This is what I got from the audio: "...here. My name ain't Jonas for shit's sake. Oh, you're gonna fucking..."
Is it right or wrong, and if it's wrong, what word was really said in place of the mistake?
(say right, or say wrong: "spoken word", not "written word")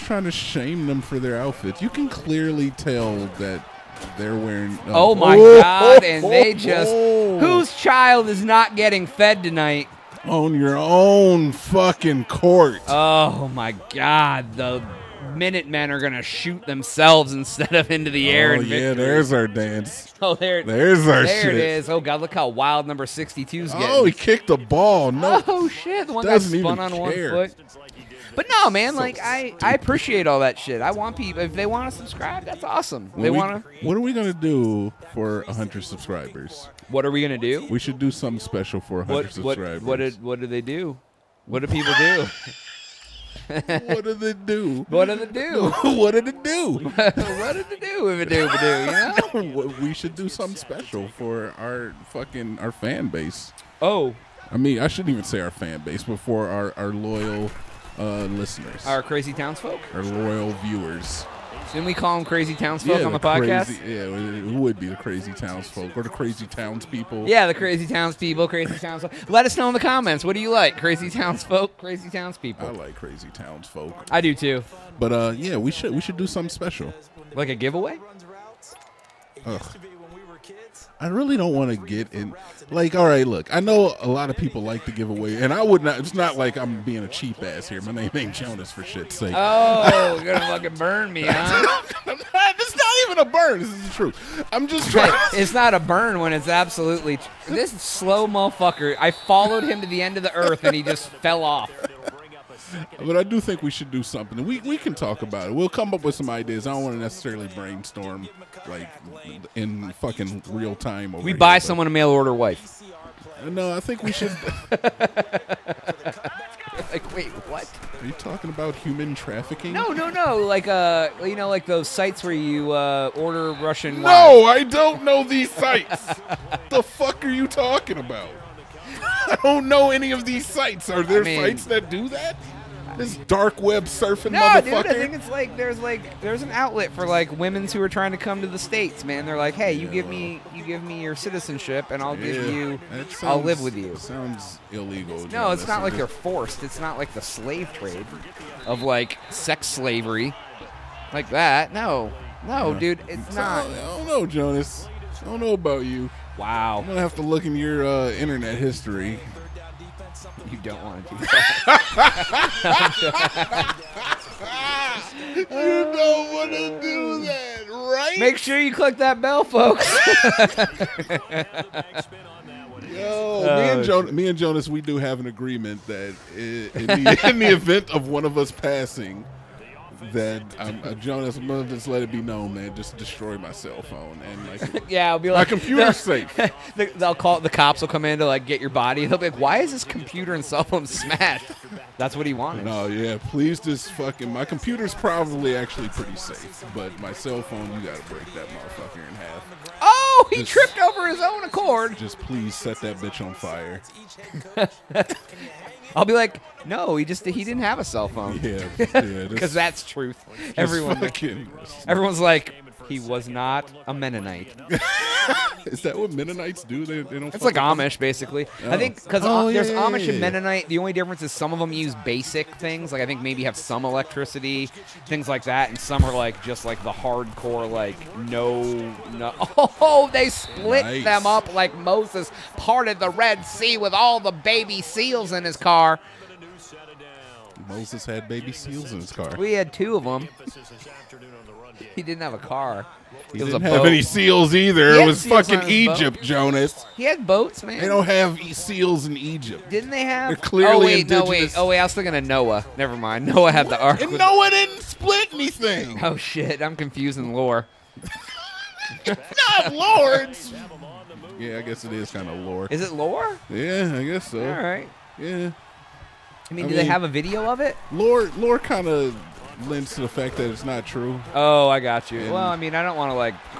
right.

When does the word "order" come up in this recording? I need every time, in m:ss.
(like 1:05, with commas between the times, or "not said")
1:52, 2:03.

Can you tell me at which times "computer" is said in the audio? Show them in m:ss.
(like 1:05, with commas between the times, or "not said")
3:05, 3:09, 3:14.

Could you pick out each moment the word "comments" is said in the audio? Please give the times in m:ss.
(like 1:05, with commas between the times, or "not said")
1:09.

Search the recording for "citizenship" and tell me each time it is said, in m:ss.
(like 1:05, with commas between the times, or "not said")
2:21.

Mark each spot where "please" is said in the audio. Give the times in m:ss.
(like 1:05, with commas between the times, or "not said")
3:13, 3:22.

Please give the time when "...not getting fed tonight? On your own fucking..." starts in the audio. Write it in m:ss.
0:08.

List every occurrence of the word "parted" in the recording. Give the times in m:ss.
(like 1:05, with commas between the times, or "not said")
3:52.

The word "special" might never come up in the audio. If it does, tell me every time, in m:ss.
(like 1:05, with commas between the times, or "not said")
0:38, 0:50, 1:16.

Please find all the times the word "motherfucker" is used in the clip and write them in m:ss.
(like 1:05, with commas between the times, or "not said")
1:38, 2:14, 3:18.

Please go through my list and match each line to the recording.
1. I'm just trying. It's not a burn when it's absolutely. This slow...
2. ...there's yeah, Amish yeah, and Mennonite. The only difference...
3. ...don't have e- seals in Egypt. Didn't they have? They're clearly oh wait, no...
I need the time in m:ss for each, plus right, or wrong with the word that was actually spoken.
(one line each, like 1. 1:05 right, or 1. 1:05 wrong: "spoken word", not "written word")
1. 1:34 right
2. 3:39 right
3. 4:07 right.